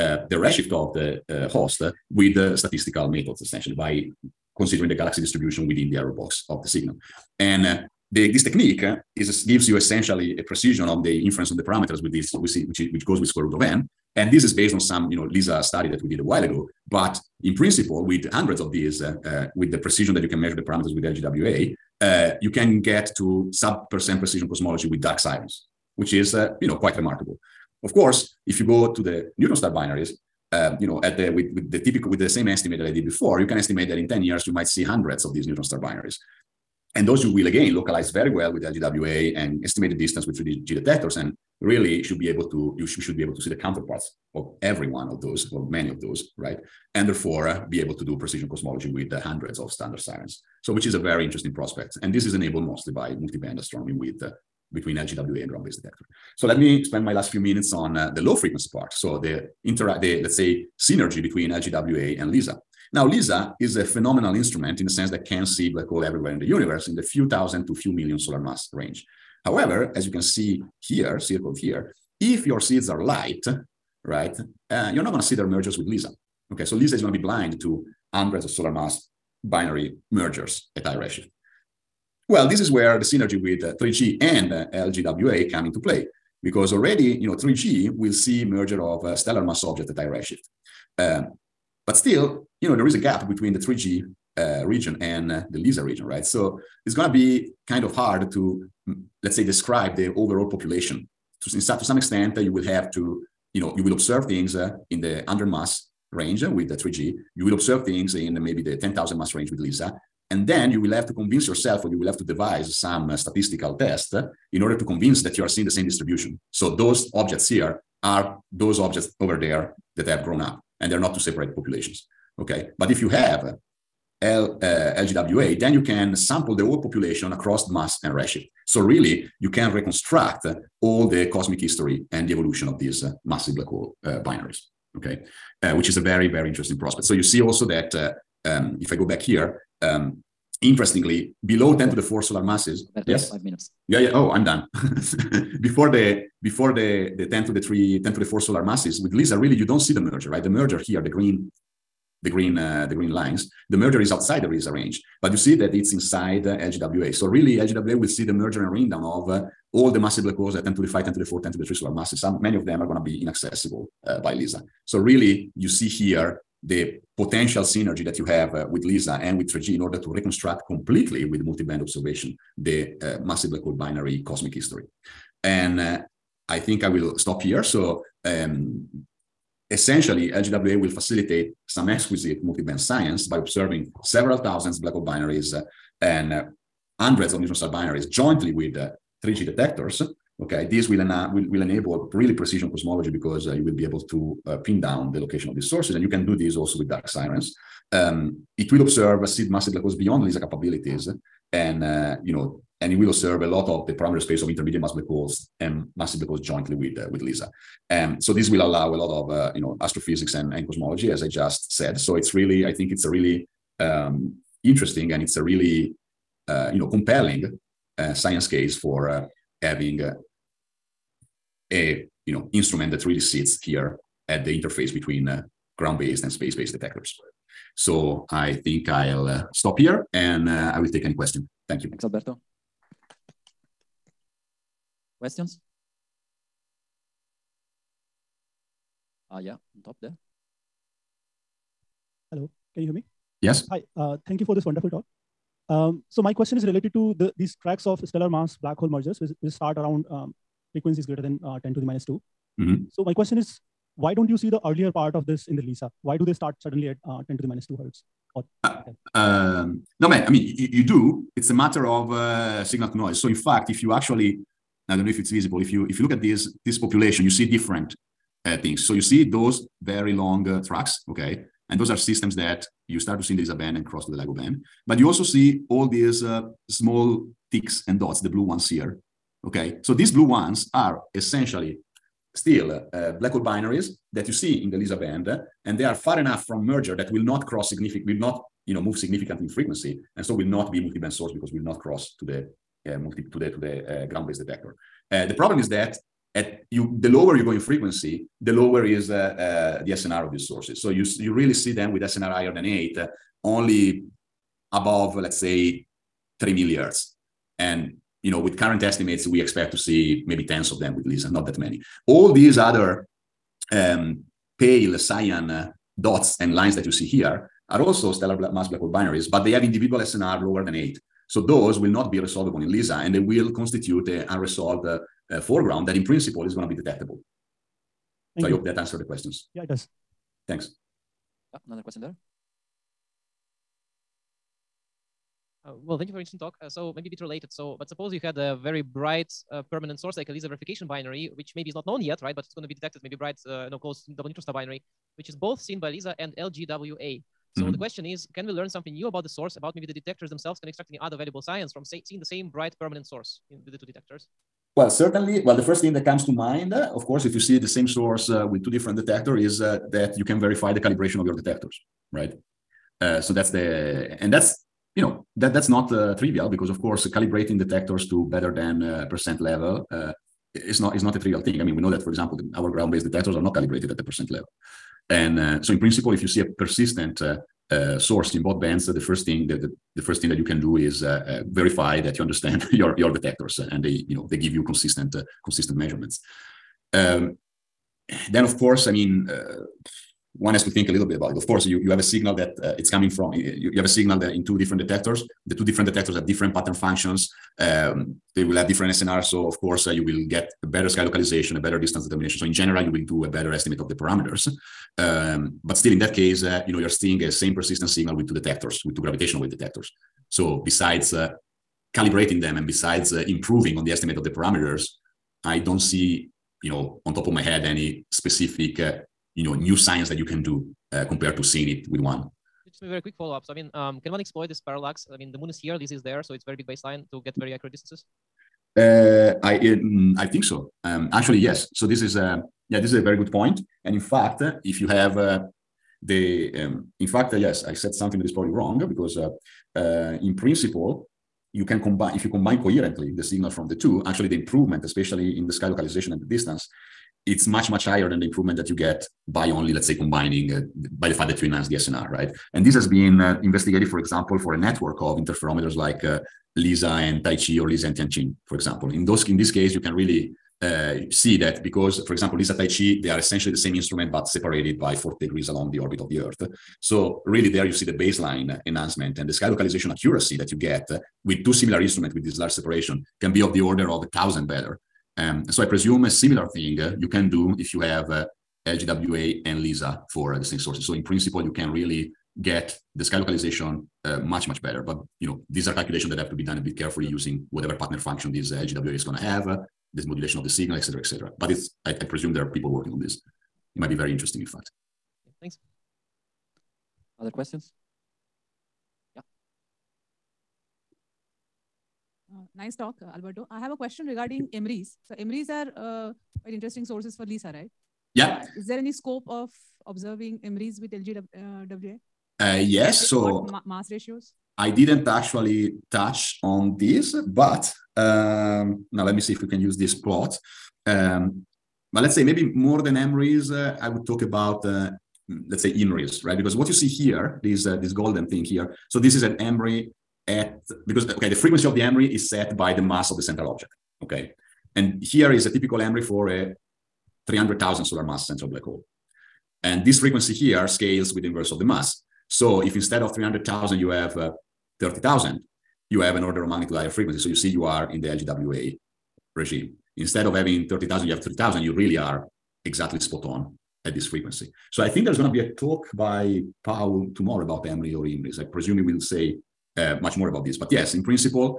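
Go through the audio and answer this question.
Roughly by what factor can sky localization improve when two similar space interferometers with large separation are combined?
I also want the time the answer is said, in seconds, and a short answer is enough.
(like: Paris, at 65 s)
a thousand, at 474 s.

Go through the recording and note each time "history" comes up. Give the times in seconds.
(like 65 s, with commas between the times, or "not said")
131 s, 174 s.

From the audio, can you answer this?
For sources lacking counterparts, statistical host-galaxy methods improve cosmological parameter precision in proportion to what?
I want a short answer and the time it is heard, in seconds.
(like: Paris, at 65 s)
square root of n, at 13 s.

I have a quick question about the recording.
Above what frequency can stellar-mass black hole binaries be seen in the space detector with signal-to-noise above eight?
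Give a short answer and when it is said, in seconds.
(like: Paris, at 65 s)
3 millihertz, at 306 s.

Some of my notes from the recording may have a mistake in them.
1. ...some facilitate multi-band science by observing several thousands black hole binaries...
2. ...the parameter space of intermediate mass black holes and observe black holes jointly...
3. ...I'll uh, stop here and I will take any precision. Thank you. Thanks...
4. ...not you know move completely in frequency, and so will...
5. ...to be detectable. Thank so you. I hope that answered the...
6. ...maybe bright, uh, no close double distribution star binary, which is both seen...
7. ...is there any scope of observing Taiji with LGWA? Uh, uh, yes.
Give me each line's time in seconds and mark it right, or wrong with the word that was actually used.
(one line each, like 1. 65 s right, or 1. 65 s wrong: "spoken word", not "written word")
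1. 181 s wrong: "exquisite", not "facilitate"
2. 203 s wrong: "massive", not "observe"
3. 228 s wrong: "question", not "precision"
4. 288 s wrong: "significantly", not "completely"
5. 326 s right
6. 343 s wrong: "neutron", not "distribution"
7. 508 s wrong: "EMRIs", not "Taiji".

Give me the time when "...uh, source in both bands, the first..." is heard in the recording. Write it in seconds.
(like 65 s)
377 s.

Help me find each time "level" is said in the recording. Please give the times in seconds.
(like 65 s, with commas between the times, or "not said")
369 s, 374 s.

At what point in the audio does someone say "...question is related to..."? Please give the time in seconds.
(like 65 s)
246 s.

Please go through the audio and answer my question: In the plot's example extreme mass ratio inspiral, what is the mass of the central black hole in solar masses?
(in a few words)
300,000.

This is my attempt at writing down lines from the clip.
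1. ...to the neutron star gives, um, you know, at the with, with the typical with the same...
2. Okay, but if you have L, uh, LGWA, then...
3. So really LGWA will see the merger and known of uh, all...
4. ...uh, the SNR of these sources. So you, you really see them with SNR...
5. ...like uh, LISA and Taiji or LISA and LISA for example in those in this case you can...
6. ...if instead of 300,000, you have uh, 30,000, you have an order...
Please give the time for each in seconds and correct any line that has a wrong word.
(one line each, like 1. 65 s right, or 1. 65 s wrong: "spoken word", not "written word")
1. 28 s wrong: "binaries", not "gives"
2. 122 s right
3. 157 s wrong: "ringdown", not "known"
4. 299 s right
5. 455 s wrong: "TianQin", not "LISA"
6. 542 s right.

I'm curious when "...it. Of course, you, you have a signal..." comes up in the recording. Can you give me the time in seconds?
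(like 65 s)
391 s.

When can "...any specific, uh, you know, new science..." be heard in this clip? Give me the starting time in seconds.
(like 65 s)
417 s.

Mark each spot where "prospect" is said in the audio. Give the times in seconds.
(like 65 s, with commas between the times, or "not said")
51 s, 136 s.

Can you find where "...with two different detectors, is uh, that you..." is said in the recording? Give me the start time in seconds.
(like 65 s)
358 s.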